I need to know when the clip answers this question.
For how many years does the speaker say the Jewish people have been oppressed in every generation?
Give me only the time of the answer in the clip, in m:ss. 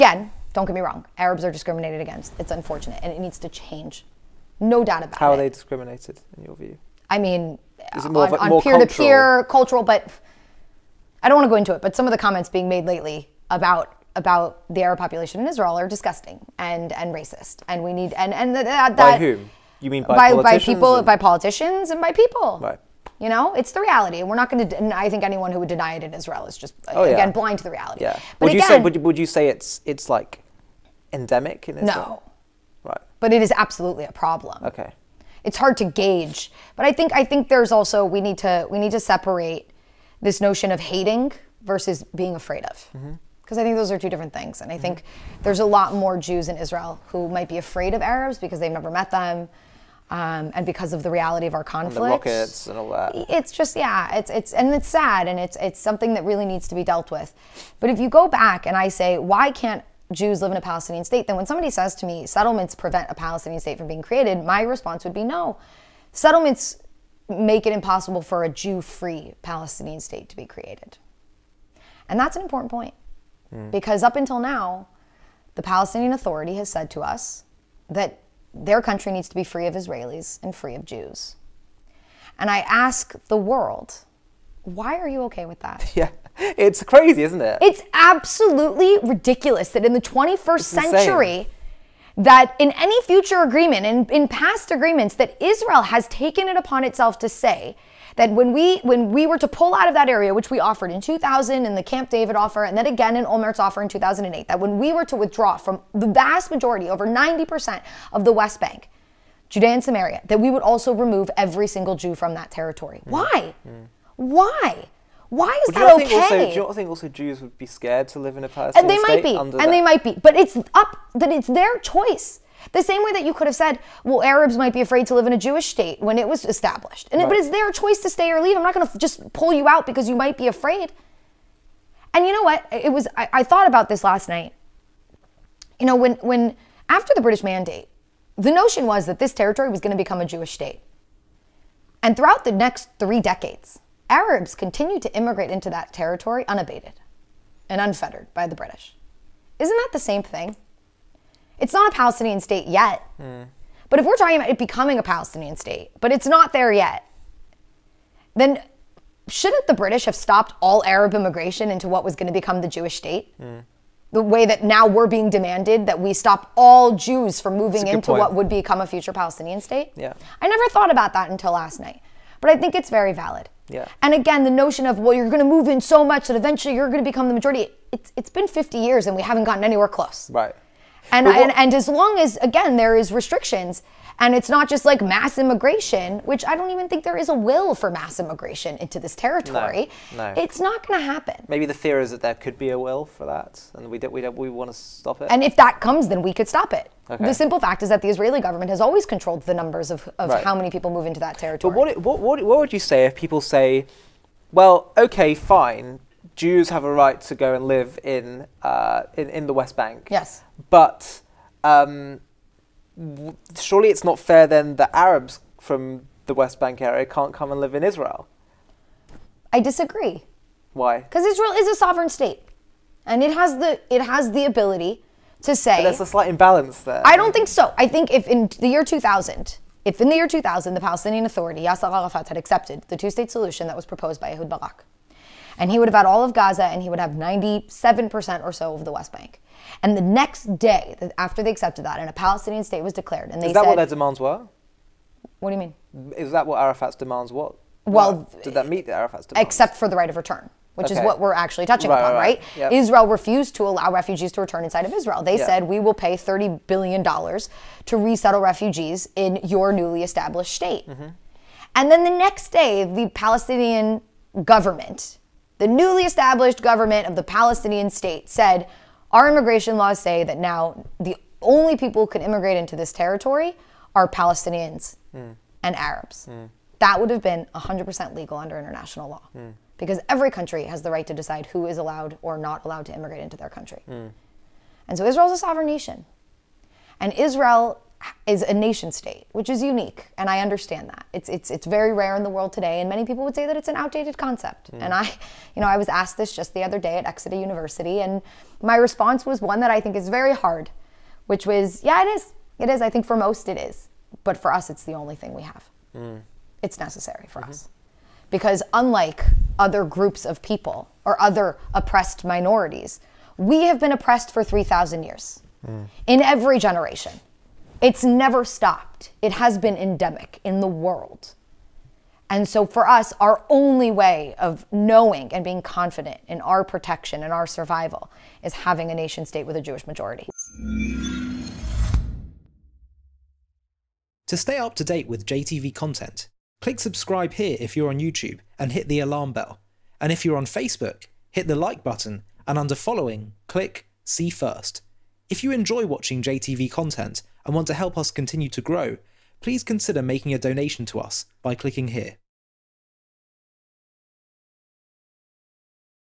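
5:14.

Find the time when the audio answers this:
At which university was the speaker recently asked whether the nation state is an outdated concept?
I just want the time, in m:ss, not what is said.
4:57.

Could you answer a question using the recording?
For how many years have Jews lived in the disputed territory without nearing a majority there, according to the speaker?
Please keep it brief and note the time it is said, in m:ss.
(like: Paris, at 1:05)
50, at 2:58.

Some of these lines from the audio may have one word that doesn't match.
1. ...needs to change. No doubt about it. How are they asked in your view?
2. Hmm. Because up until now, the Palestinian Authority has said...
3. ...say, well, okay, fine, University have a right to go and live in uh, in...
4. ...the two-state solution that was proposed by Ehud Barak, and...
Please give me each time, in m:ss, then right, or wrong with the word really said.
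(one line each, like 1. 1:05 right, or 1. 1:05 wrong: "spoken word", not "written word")
1. 0:03 wrong: "discriminated", not "asked"
2. 1:13 right
3. 3:23 wrong: "Jews", not "University"
4. 3:52 right.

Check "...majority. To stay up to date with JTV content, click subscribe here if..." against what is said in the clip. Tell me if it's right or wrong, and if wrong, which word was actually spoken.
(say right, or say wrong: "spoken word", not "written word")
right.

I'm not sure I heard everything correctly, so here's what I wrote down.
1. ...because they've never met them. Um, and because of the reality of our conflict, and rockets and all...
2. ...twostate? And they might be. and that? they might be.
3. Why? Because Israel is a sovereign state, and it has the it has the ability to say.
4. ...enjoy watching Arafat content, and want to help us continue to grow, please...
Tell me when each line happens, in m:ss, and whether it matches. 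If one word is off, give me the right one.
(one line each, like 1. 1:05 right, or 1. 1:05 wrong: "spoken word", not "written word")
1. 0:48 right
2. 1:59 wrong: "state", not "twostate"
3. 3:40 right
4. 5:45 wrong: "JTV", not "Arafat".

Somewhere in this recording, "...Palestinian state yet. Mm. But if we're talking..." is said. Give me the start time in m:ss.
2:31.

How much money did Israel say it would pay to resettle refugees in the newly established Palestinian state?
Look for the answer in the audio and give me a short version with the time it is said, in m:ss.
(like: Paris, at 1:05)
$30 billion, at 4:16.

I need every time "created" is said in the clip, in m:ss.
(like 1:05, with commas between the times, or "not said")
1:04, 1:10.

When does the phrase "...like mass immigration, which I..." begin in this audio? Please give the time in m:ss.
3:04.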